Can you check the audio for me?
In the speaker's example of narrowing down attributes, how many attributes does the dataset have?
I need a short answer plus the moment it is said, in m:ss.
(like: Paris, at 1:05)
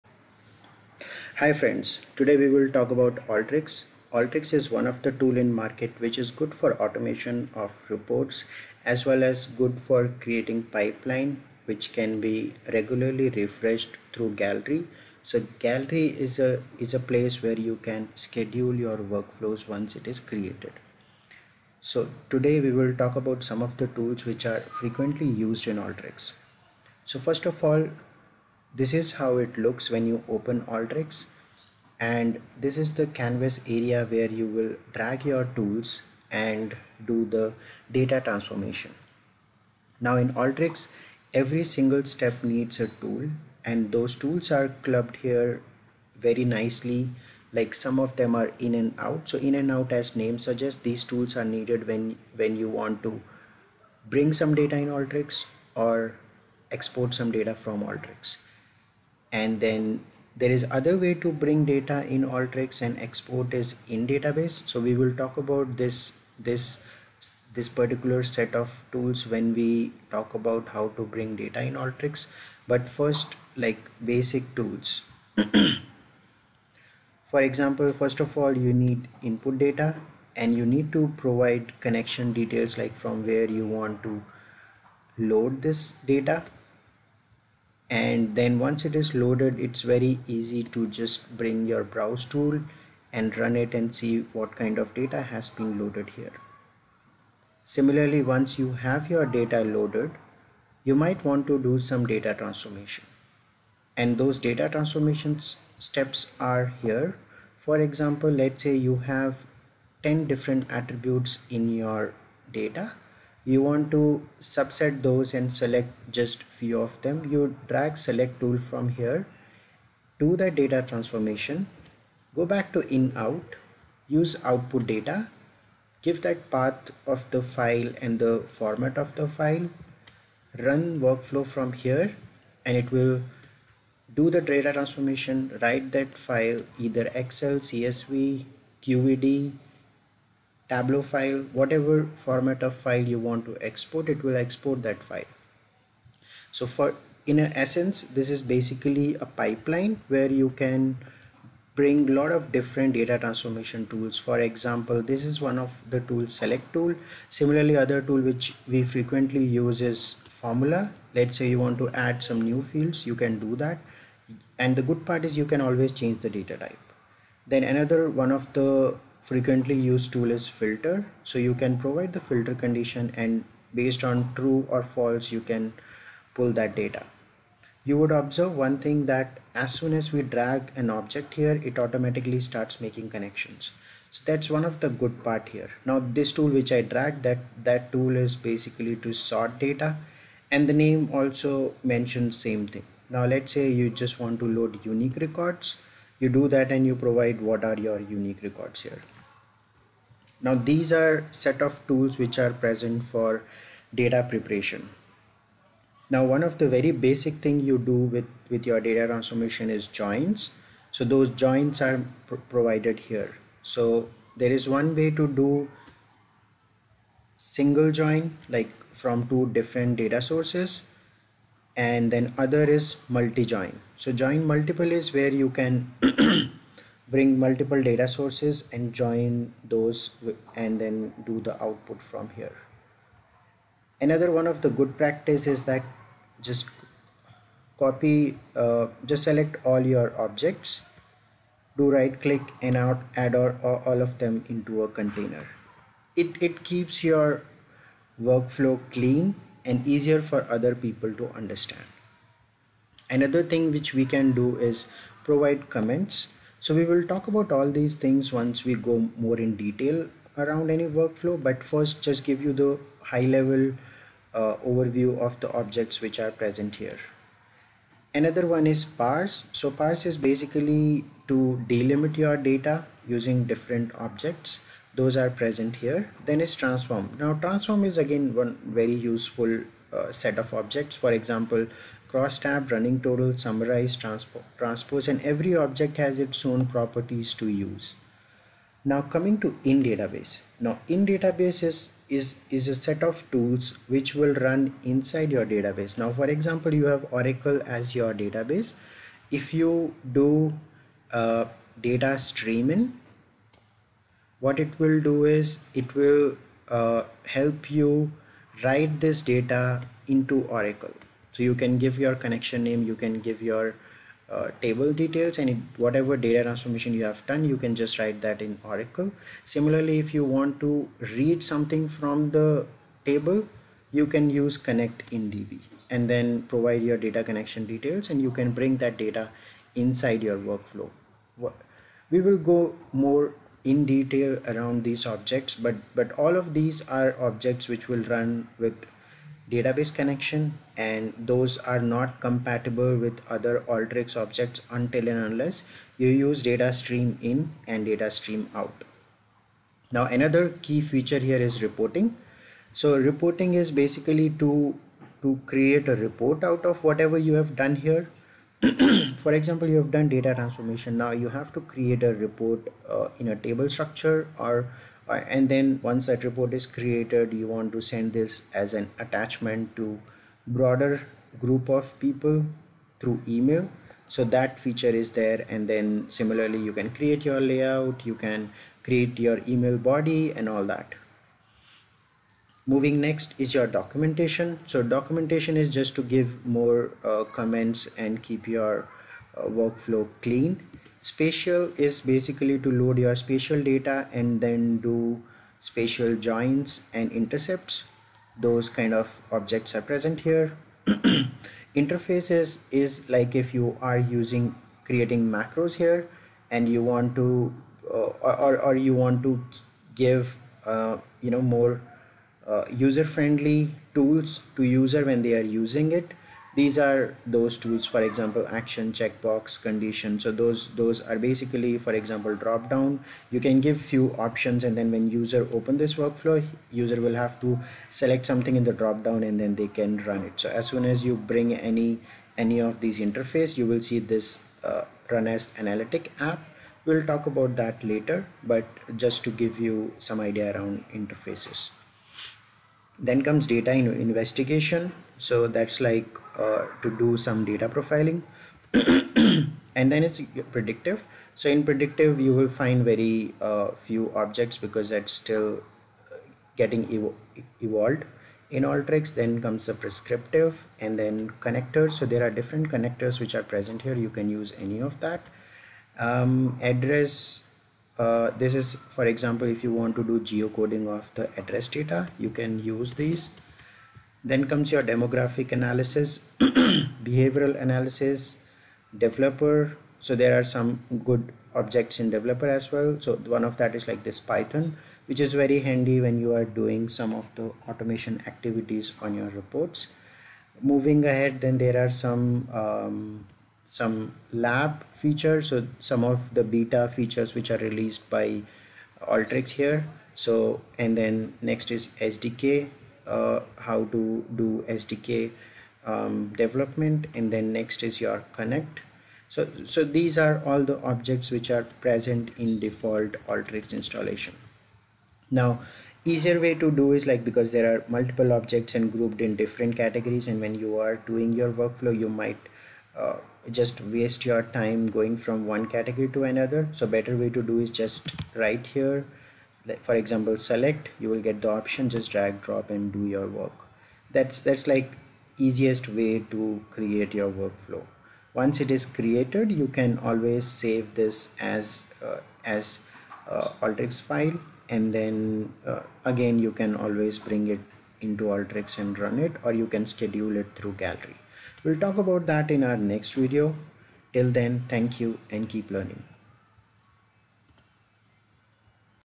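10, at 1:50.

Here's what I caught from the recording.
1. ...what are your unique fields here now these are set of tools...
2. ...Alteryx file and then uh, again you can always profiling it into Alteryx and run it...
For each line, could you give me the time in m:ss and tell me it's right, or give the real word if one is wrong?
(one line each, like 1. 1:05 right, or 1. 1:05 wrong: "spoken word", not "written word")
1. 3:17 wrong: "records", not "fields"
2. 9:03 wrong: "bring", not "profiling".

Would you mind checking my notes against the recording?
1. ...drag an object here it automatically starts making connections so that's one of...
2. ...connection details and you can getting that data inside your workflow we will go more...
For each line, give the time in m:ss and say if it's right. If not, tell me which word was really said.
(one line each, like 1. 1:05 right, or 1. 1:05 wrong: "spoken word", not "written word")
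1. 3:00 right
2. 5:27 wrong: "bring", not "getting".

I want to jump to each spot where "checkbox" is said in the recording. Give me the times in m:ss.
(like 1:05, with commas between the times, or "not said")
6:58.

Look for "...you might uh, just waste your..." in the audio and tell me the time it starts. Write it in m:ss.
8:41.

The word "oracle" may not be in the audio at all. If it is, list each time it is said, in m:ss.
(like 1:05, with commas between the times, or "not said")
4:57, 5:10, 5:18.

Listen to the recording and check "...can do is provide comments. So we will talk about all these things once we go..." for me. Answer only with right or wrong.
right.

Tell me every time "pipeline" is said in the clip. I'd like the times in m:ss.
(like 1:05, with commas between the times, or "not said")
0:10, 2:29.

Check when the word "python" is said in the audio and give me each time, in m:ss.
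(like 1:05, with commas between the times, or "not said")
8:04.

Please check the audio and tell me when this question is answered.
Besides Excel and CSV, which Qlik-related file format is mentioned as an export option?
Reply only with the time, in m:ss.
2:18.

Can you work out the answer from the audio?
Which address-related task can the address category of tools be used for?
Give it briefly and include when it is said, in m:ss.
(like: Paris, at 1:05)
Geocoding, at 7:50.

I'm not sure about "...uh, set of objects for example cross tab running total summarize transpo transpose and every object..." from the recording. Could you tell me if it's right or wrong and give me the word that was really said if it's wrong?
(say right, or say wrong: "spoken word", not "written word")
right.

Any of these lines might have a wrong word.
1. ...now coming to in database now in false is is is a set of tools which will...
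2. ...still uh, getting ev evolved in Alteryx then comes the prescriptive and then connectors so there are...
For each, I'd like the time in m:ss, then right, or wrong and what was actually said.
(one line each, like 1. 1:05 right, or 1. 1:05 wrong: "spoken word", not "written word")
1. 4:48 wrong: "database", not "false"
2. 7:35 right.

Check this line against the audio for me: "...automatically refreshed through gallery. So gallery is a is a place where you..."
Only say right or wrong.
wrong.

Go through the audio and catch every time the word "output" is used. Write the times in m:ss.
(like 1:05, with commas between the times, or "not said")
2:04, 3:51.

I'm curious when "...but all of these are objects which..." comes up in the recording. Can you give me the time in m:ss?
5:35.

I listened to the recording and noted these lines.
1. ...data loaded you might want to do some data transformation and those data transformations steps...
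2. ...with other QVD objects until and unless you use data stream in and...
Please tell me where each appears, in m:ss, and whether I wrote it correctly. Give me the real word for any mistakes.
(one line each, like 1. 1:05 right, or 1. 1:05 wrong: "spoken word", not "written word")
1. 1:39 right
2. 5:42 wrong: "Alteryx", not "QVD".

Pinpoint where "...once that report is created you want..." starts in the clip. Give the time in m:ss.
6:05.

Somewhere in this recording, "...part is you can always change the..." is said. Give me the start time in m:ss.
2:45.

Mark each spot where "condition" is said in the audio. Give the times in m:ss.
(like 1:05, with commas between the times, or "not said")
2:52, 6:59.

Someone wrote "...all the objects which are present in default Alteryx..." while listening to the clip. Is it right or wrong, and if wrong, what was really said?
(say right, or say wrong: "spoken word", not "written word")
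right.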